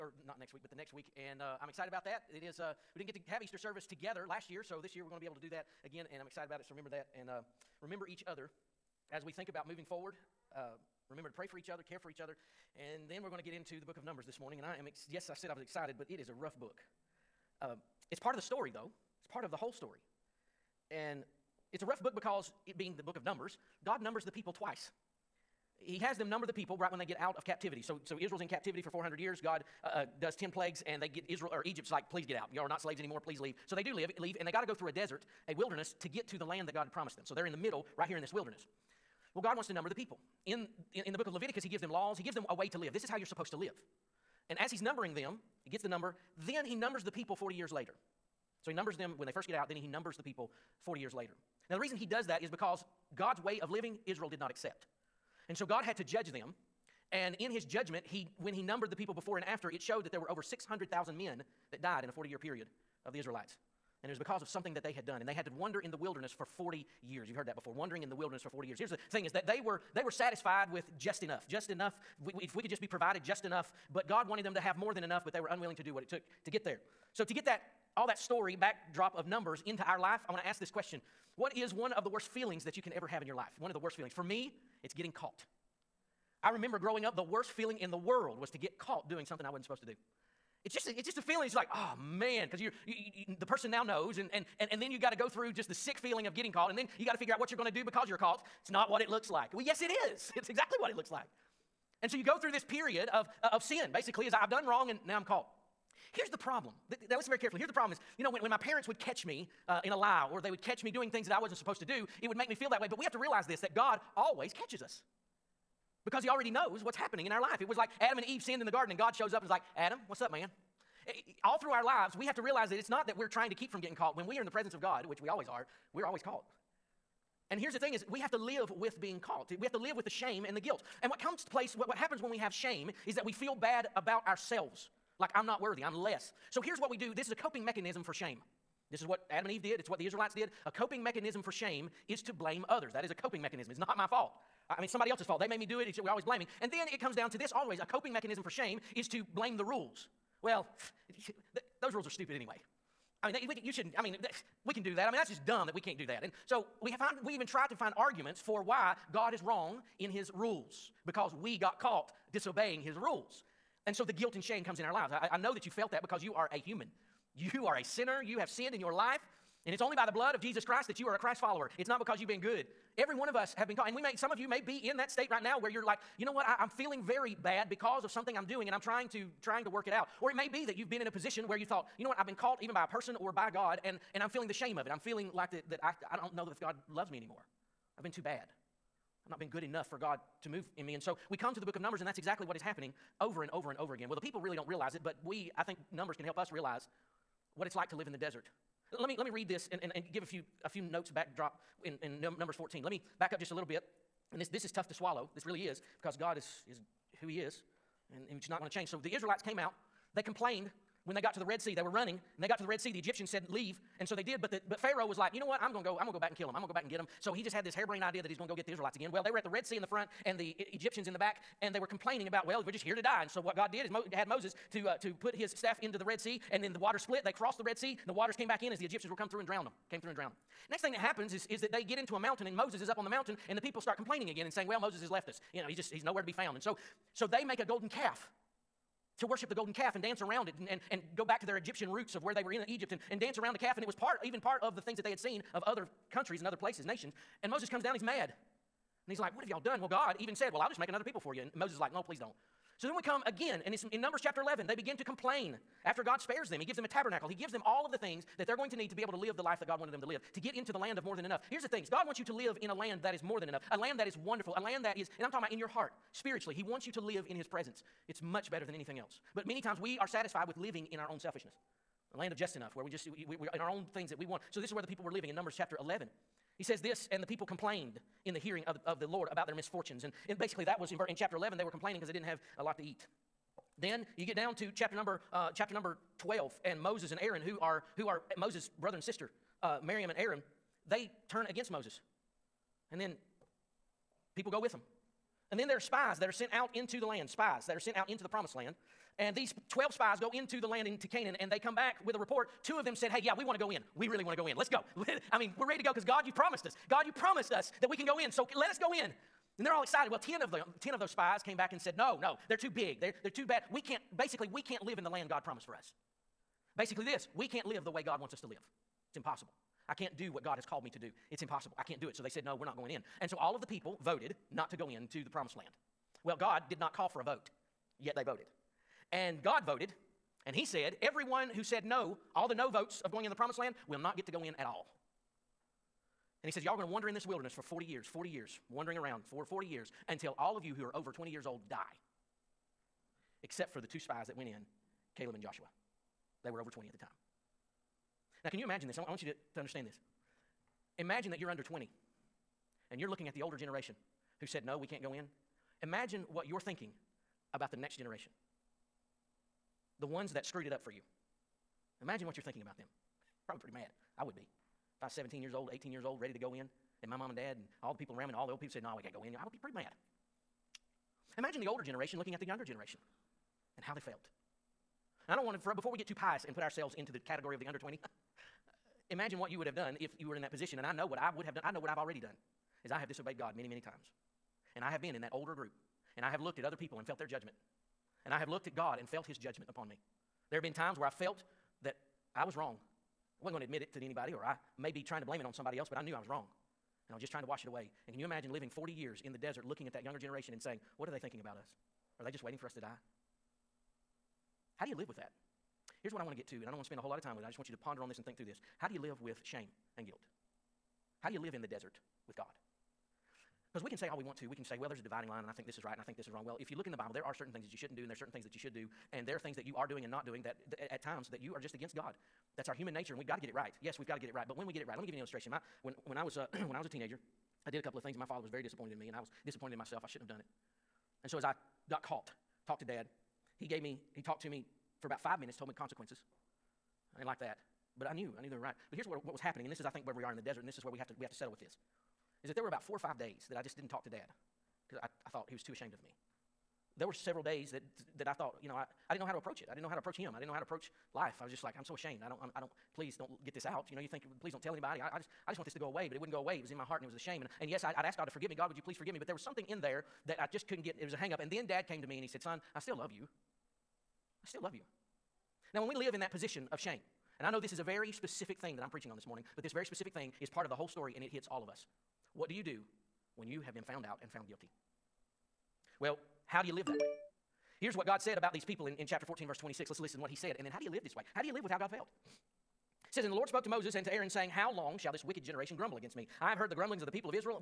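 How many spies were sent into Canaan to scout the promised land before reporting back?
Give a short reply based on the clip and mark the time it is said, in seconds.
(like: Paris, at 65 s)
12, at 299 s.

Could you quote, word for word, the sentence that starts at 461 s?
And then dad came to me and he said, Son, I still love you.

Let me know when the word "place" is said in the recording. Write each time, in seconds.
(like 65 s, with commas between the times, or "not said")
131 s, 246 s.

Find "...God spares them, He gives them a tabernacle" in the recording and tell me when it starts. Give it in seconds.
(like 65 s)
256 s.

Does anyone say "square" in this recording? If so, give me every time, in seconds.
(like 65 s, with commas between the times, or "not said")
not said.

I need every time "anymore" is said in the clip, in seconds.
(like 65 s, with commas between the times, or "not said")
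32 s, 187 s.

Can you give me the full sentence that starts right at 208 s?
So the Israelites came out they complained when they got to the Red Sea.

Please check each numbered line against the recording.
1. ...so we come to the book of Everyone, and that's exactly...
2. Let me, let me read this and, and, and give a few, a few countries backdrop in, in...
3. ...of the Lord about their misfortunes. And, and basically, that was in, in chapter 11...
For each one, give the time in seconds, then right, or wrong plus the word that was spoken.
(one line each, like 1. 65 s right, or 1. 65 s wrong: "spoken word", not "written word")
1. 191 s wrong: "Numbers", not "Everyone"
2. 198 s wrong: "notes", not "countries"
3. 278 s right.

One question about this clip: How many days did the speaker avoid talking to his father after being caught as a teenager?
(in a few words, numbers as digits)
4 or 5.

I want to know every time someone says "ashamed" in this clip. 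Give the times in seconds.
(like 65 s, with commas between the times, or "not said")
445 s, 451 s.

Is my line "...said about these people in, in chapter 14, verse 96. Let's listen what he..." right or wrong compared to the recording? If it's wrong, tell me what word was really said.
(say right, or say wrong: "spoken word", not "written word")
wrong: "26", not "96".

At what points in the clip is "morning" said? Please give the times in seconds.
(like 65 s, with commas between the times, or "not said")
14 s, 469 s.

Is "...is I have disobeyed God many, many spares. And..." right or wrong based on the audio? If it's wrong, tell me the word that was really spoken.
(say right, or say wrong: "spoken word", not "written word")
wrong: "times", not "spares".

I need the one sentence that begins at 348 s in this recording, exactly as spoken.
I want you to, to understand this.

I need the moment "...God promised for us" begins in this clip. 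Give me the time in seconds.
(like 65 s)
315 s.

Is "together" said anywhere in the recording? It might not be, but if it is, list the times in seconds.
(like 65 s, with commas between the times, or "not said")
3 s.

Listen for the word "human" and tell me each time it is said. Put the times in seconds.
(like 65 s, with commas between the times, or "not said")
166 s, 422 s.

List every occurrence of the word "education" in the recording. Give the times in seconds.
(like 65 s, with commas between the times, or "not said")
not said.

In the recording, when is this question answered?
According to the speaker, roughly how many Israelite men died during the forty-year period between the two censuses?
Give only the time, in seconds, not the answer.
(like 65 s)
60 s.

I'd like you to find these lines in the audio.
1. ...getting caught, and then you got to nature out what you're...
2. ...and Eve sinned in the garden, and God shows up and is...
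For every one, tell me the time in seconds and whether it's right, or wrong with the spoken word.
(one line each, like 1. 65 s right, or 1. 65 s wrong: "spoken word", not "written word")
1. 96 s wrong: "figure", not "nature"
2. 118 s right.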